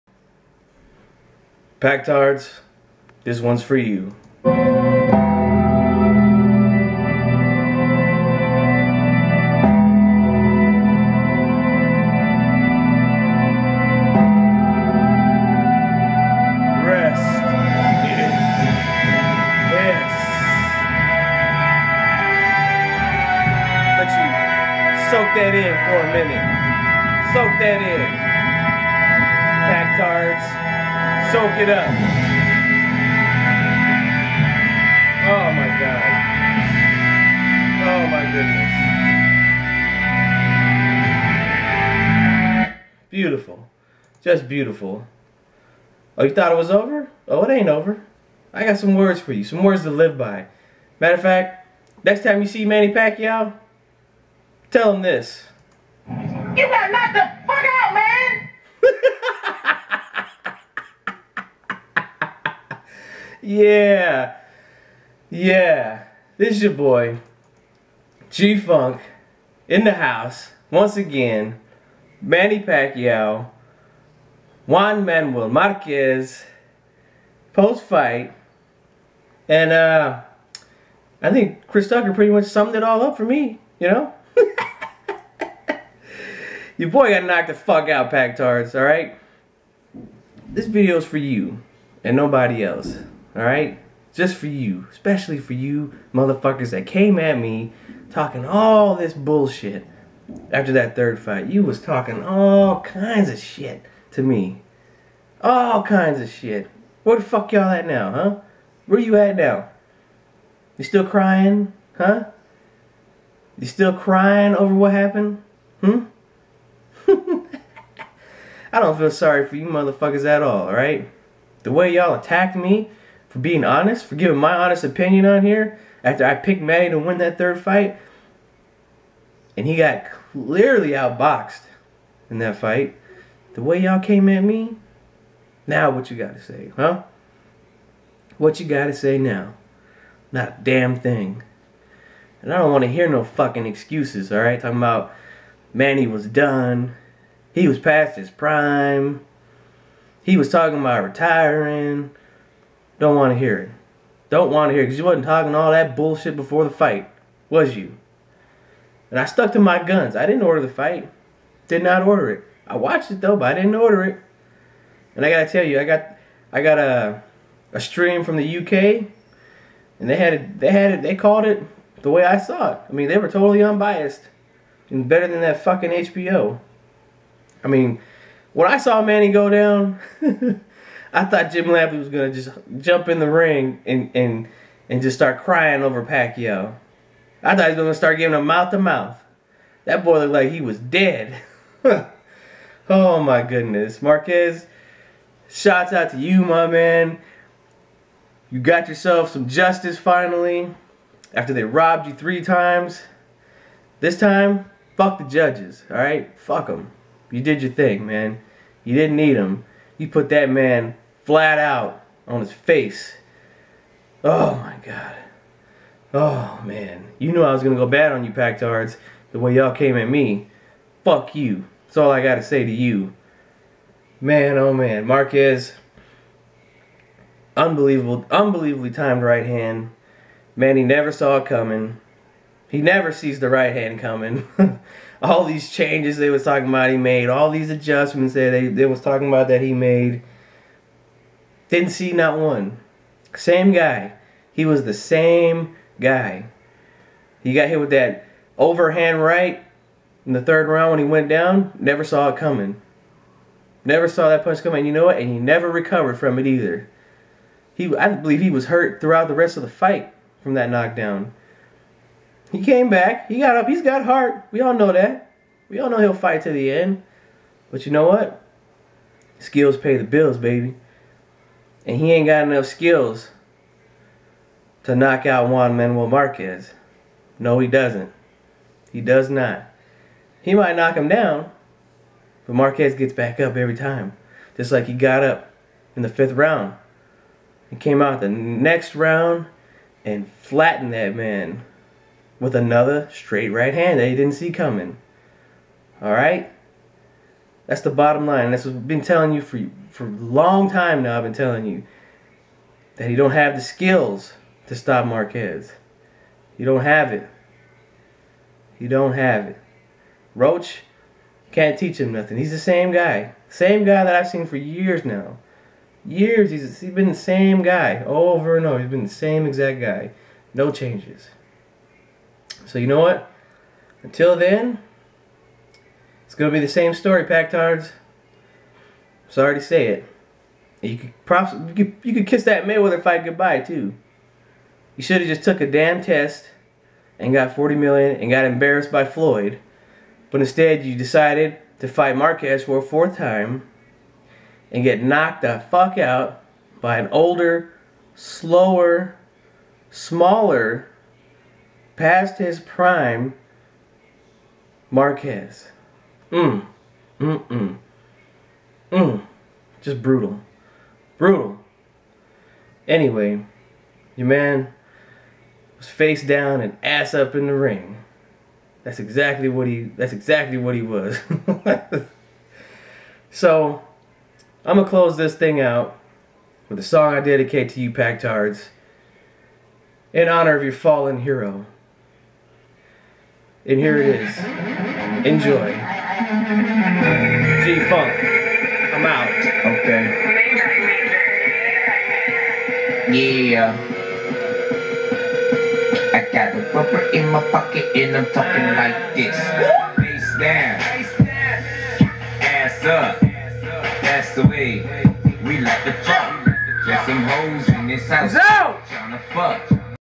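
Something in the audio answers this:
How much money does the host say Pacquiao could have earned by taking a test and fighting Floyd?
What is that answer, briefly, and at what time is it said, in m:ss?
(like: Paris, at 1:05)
40 million, at 5:37.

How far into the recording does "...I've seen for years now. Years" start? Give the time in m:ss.
5:14.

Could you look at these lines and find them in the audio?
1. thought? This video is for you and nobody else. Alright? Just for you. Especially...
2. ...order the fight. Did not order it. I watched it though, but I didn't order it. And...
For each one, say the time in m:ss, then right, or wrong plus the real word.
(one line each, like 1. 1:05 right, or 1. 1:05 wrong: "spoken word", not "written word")
1. 1:28 wrong: "alright", not "thought"
2. 2:40 right.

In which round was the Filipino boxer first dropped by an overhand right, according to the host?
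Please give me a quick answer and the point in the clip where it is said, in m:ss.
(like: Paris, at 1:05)
Third round, at 4:10.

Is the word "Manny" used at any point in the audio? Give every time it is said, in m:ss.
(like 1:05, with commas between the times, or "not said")
0:52, 1:12, 2:06, 2:25, 2:59.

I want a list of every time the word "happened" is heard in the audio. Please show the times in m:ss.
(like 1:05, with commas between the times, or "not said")
1:54.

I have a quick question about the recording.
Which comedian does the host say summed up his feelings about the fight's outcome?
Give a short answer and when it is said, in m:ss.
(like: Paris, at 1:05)
Chris Tucker, at 1:21.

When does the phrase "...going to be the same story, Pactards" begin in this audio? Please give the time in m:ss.
5:26.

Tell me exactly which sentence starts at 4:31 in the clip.
And he ain't got enough skills to knock out Juan Manuel Marquez.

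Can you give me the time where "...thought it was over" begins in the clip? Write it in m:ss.
0:46.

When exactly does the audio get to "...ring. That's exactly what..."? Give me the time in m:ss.
6:07.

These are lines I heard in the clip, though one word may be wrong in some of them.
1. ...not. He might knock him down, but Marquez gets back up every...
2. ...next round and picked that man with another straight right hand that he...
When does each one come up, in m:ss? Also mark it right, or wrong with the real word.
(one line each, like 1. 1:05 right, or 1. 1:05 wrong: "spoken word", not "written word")
1. 4:39 right
2. 4:48 wrong: "flattened", not "picked".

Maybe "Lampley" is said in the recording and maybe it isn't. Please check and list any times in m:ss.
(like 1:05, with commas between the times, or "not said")
3:01.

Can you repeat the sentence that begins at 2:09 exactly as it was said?
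And he got clearly outboxed in that fight.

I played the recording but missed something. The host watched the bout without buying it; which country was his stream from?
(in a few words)
UK.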